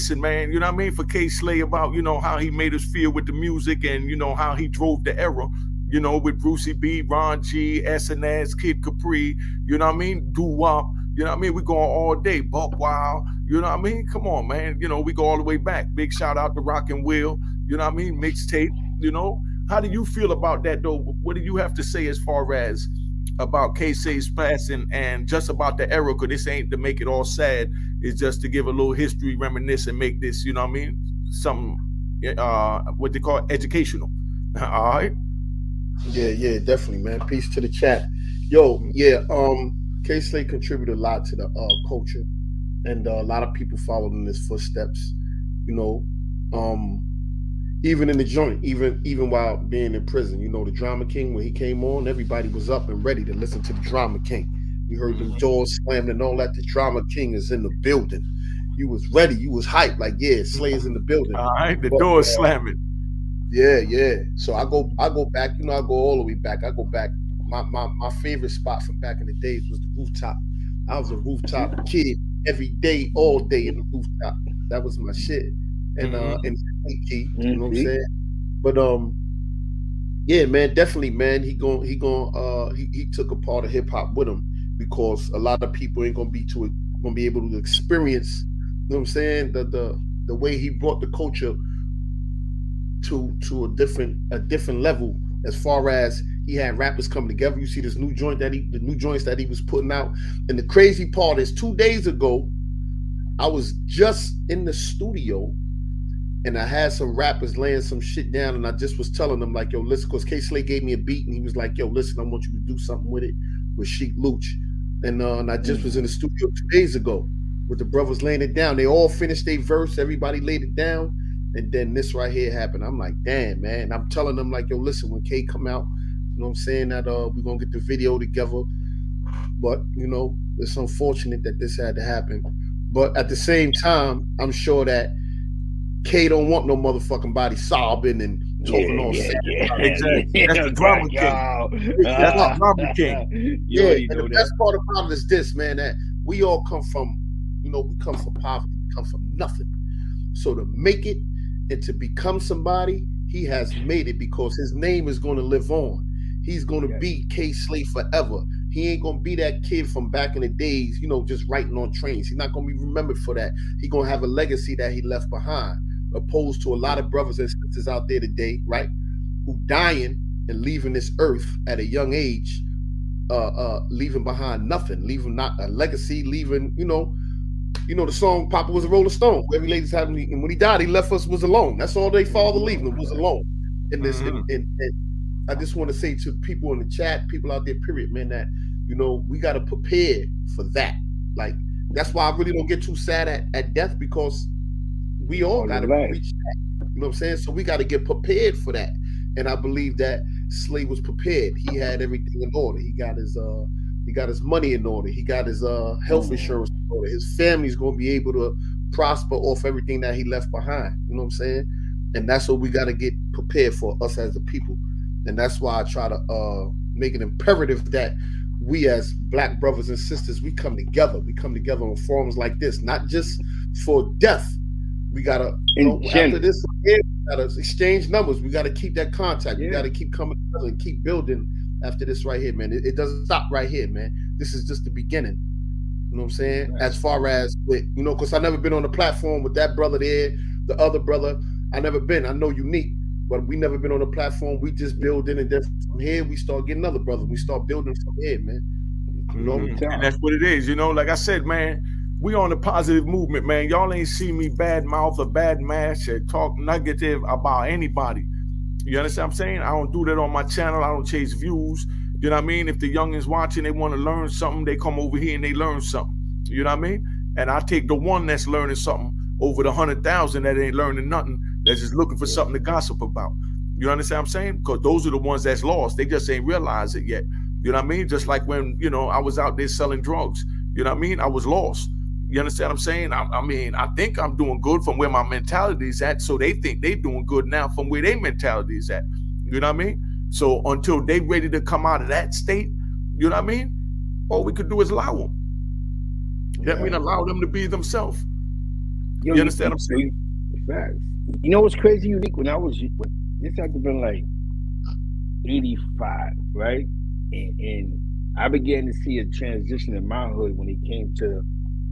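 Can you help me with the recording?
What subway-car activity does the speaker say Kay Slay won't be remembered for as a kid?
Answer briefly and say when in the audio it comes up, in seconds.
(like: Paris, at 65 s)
writing on trains, at 161 s.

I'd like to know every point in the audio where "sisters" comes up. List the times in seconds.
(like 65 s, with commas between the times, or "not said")
167 s, 219 s.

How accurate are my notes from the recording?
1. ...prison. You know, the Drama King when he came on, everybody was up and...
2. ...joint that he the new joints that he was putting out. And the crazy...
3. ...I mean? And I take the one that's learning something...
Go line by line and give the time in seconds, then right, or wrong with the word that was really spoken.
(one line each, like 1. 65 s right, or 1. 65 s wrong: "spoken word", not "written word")
1. 50 s right
2. 98 s right
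3. 266 s right.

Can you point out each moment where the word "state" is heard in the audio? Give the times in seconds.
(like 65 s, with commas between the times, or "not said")
292 s.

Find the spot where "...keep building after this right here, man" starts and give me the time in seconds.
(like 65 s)
230 s.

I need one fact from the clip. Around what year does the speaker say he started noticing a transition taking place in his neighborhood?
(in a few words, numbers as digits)
1985.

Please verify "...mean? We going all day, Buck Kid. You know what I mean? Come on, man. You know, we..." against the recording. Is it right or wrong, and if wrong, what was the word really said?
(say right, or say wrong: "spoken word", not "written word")
wrong: "Wild", not "Kid".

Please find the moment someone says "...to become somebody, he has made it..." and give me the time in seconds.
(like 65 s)
151 s.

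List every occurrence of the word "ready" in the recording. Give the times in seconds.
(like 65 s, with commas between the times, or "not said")
53 s, 59 s, 291 s.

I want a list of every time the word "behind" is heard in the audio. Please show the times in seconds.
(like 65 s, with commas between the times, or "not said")
165 s, 174 s, 210 s.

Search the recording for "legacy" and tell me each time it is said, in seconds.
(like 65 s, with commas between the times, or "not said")
164 s, 175 s.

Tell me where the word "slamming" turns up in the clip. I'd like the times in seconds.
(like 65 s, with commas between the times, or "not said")
55 s, 62 s.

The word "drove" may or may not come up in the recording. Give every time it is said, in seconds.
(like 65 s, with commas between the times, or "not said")
4 s.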